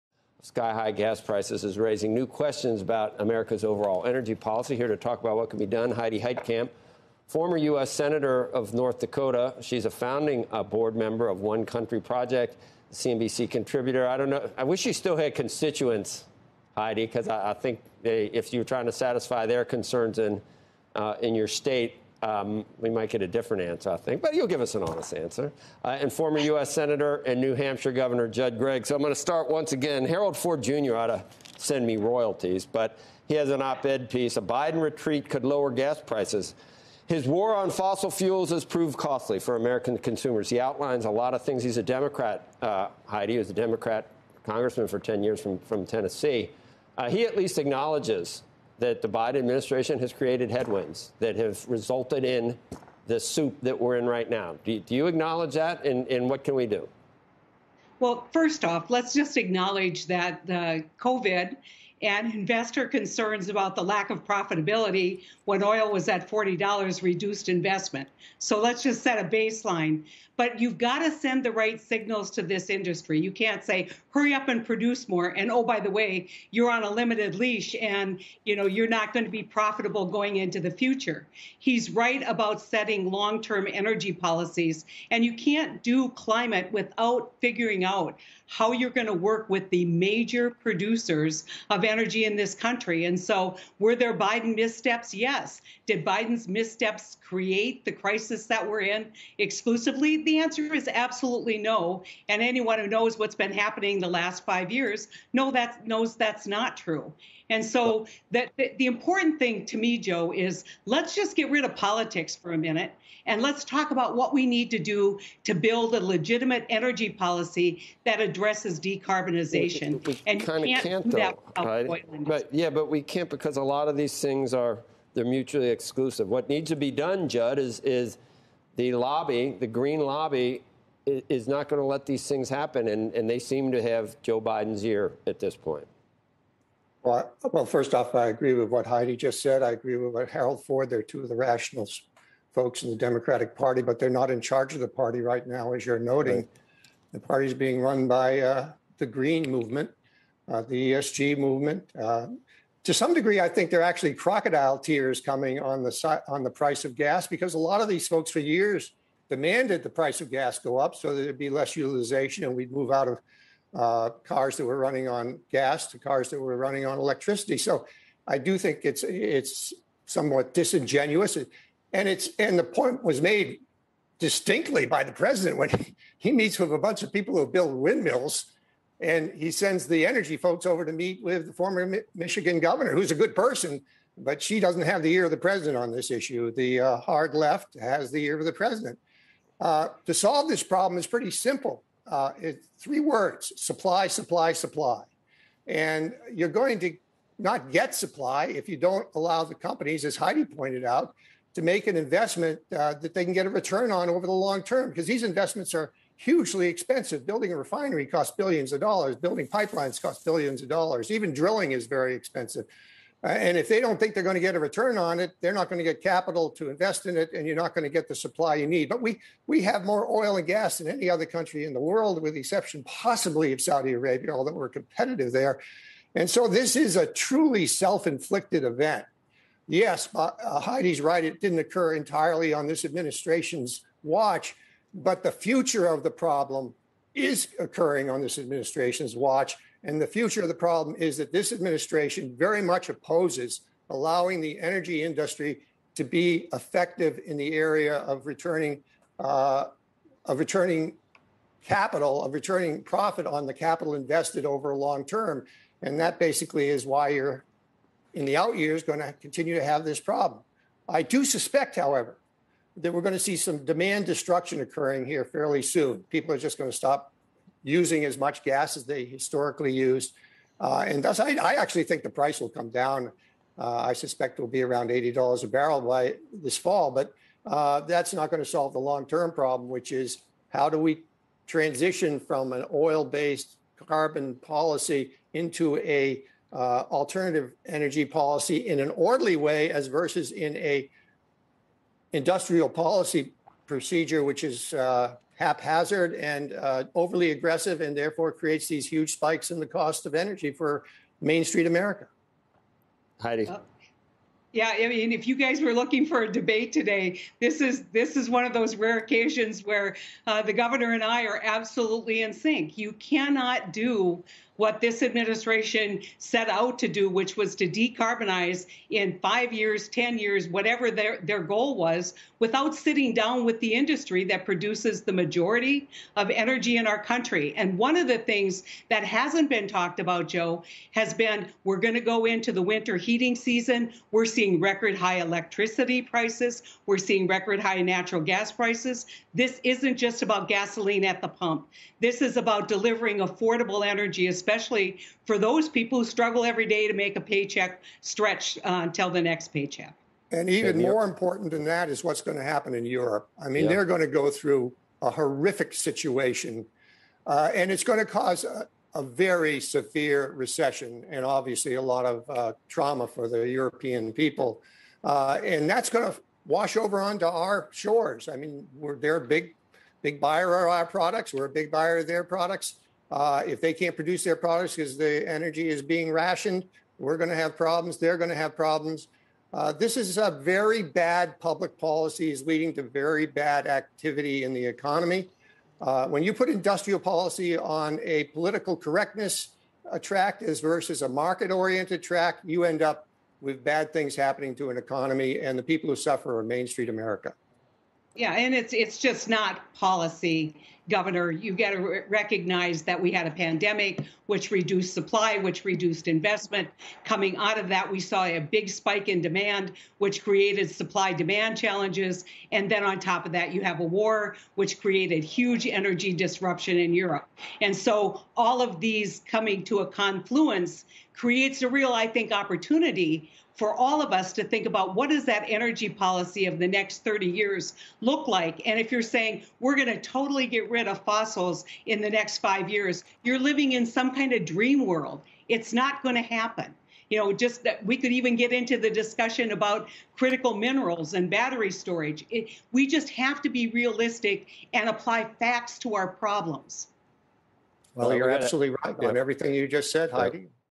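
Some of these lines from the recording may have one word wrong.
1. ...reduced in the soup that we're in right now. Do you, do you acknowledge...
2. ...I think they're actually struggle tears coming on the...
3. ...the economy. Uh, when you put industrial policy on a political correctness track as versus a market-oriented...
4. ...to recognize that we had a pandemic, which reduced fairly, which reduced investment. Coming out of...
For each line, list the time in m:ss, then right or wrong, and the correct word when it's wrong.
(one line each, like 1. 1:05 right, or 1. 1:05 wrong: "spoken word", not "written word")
1. 0:51 wrong: "resulted", not "reduced"
2. 2:33 wrong: "crocodile", not "struggle"
3. 6:24 right
4. 6:41 wrong: "supply", not "fairly".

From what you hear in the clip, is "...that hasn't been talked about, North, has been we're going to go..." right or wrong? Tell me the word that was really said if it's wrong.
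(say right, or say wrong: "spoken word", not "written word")
wrong: "Joe", not "North".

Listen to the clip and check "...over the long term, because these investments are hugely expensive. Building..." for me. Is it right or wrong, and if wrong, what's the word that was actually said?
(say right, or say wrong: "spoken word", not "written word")
right.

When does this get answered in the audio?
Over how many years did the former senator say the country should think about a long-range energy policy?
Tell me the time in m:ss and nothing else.
7:06.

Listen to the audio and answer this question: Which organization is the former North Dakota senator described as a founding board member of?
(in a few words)
One Country Project.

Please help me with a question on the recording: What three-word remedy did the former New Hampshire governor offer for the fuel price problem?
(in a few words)
supply, supply, supply.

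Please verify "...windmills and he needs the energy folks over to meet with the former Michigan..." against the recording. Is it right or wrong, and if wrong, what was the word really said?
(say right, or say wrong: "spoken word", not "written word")
wrong: "sends", not "needs".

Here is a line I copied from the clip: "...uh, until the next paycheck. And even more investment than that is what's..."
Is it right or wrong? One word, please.
wrong.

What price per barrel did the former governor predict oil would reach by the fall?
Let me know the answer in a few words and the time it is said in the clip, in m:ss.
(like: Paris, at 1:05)
$80, at 4:34.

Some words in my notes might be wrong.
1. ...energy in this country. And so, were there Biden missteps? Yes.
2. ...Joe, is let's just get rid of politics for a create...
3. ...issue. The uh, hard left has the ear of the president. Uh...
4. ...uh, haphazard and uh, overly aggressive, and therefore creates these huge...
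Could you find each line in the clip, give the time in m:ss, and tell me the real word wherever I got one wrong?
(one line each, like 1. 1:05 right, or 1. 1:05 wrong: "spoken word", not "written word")
1. 1:31 right
2. 1:49 wrong: "minute", not "create"
3. 3:06 right
4. 4:54 right.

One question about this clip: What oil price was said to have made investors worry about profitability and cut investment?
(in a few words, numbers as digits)
$40.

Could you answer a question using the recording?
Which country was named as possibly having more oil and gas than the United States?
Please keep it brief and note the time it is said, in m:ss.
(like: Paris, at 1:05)
Saudi Arabia, at 3:43.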